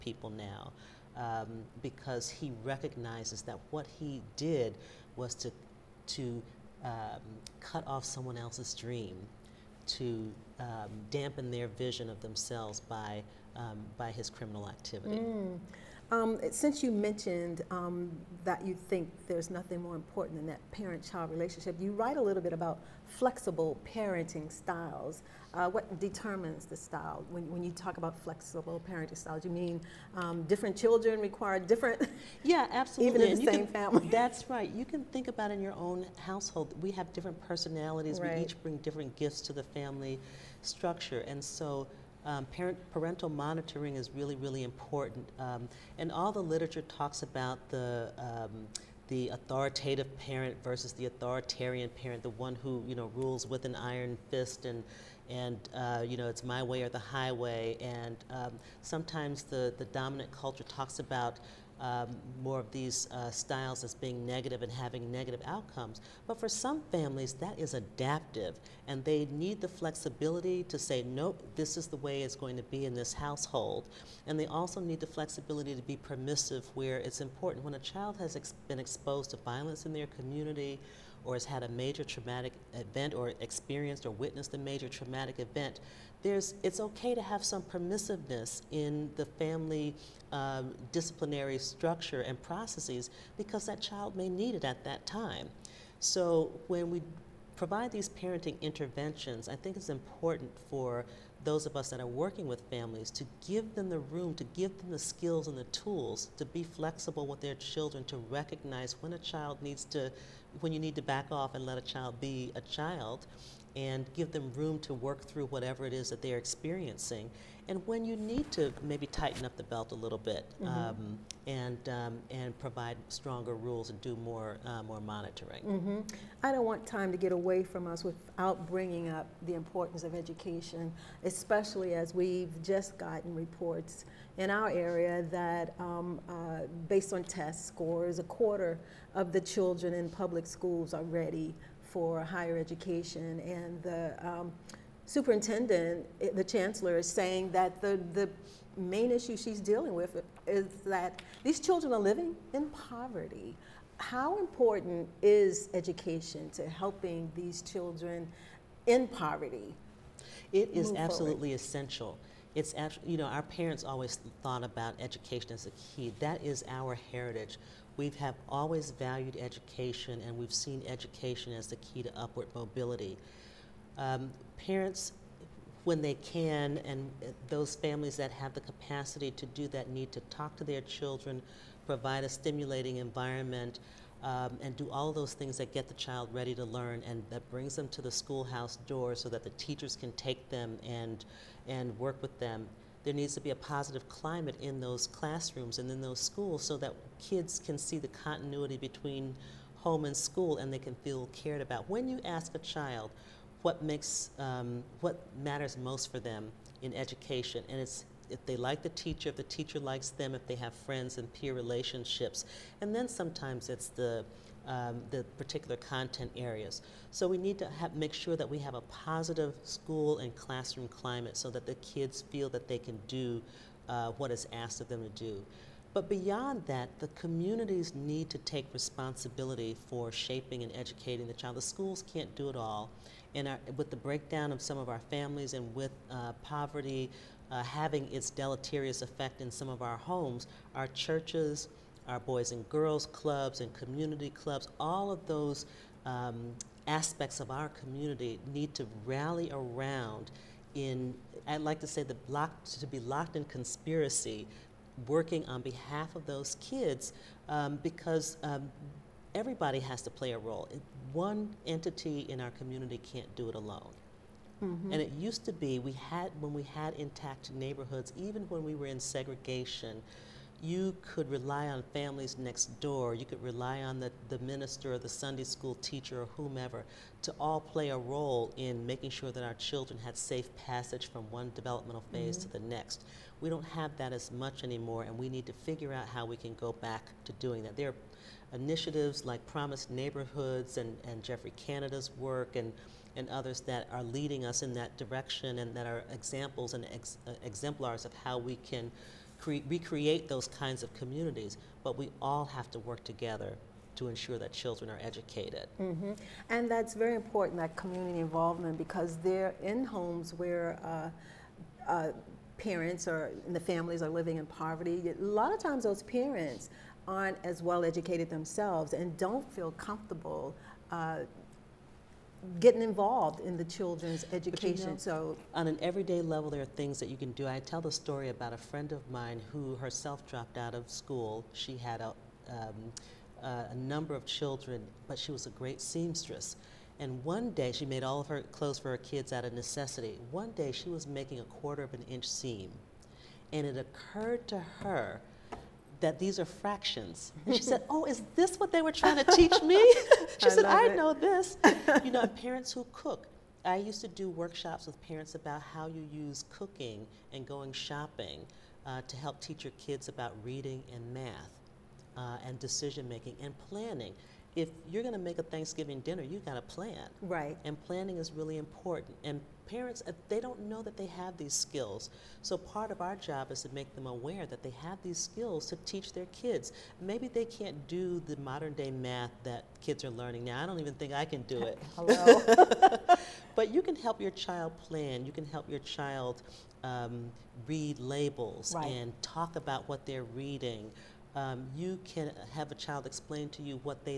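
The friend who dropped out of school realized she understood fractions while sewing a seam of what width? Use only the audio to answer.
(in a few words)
a quarter of an inch.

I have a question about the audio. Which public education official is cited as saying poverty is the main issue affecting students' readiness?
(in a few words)
the chancellor.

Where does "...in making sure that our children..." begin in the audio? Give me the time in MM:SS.
04:38.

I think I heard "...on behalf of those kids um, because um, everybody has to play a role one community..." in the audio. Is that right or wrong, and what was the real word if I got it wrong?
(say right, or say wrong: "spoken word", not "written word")
wrong: "entity", not "community".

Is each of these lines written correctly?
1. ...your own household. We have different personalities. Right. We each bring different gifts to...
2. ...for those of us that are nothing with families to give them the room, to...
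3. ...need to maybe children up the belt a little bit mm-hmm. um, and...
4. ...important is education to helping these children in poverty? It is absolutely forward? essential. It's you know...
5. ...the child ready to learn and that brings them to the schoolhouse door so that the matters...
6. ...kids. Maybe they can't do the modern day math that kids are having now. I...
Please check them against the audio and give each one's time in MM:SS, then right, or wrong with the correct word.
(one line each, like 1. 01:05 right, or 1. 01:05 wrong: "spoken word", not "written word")
1. 00:35 right
2. 01:40 wrong: "working", not "nothing"
3. 01:58 wrong: "tighten", not "children"
4. 02:34 right
5. 03:05 wrong: "teachers", not "matters"
6. 06:16 wrong: "learning", not "having".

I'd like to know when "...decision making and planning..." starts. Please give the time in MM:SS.
06:02.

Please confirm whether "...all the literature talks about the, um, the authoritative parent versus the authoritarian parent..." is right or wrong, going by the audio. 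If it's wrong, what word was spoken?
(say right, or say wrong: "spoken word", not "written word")
right.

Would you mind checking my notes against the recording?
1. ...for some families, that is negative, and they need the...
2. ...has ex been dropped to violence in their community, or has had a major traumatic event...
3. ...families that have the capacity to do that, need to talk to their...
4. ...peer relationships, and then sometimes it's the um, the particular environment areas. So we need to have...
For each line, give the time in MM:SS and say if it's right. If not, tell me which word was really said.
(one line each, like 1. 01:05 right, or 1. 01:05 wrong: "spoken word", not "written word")
1. 01:06 wrong: "adaptive", not "negative"
2. 01:18 wrong: "exposed", not "dropped"
3. 02:57 right
4. 03:31 wrong: "content", not "environment".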